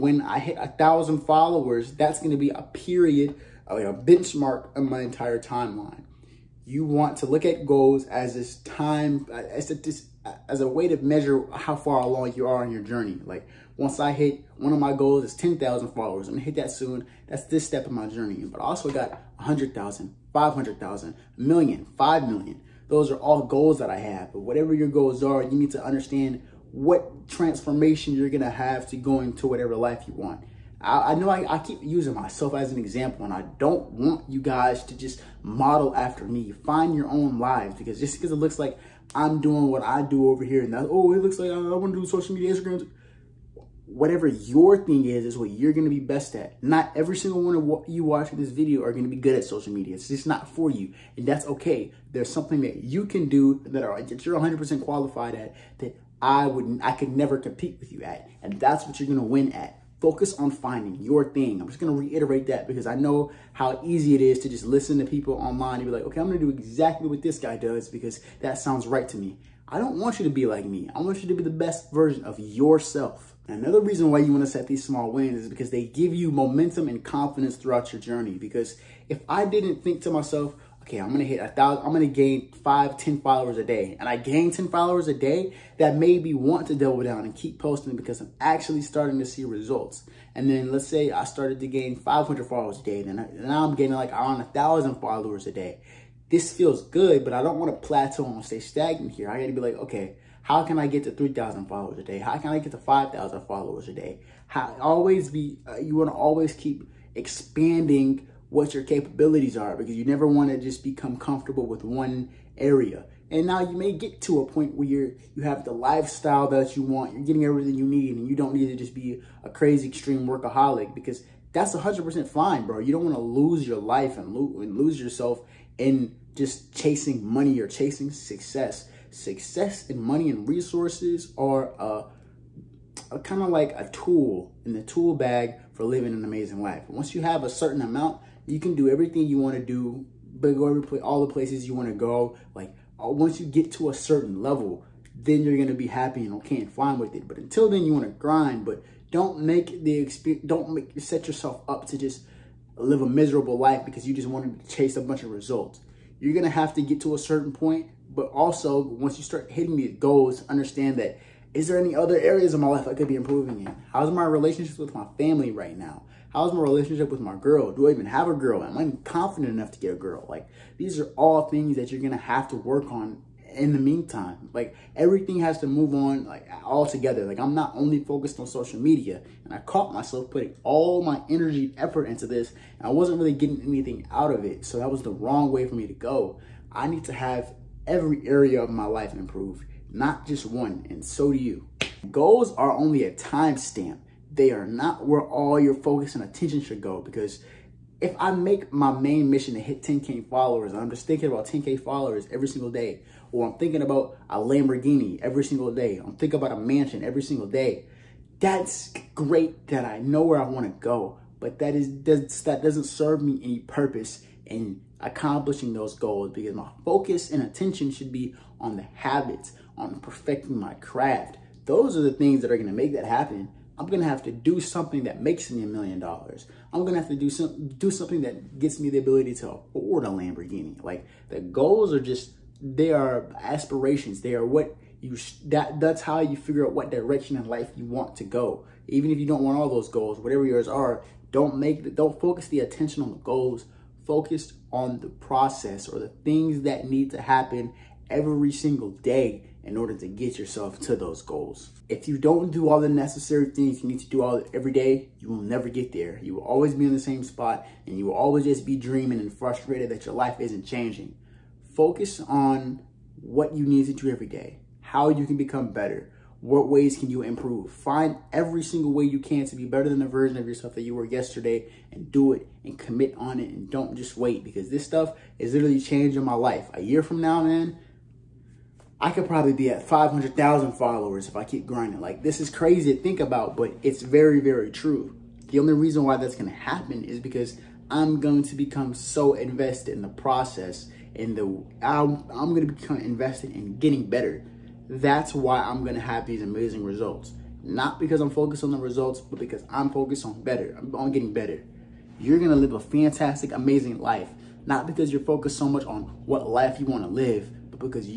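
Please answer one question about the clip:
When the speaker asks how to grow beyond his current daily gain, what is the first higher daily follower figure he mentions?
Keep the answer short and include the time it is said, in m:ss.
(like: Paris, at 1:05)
3,000, at 1:41.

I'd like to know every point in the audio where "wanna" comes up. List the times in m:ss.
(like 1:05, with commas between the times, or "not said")
1:37, 1:45.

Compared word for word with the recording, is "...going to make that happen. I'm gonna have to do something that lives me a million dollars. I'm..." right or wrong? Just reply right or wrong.
wrong.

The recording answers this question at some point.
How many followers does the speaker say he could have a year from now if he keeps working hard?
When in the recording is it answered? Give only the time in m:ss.
4:39.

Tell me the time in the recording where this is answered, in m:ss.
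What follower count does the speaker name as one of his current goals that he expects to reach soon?
0:15.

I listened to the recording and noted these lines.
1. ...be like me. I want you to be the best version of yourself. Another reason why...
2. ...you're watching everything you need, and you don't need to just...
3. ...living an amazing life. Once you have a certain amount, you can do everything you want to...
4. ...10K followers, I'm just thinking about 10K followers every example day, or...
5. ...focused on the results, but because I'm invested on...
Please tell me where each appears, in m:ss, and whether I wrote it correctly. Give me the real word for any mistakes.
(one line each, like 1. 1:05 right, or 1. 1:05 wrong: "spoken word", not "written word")
1. 1:10 right
2. 1:57 wrong: "getting", not "watching"
3. 2:15 right
4. 3:19 wrong: "single", not "example"
5. 4:58 wrong: "focused", not "invested".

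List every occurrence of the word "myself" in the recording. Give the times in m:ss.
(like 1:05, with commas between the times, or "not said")
0:32, 1:20, 2:59.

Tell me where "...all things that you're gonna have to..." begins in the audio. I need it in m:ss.
2:51.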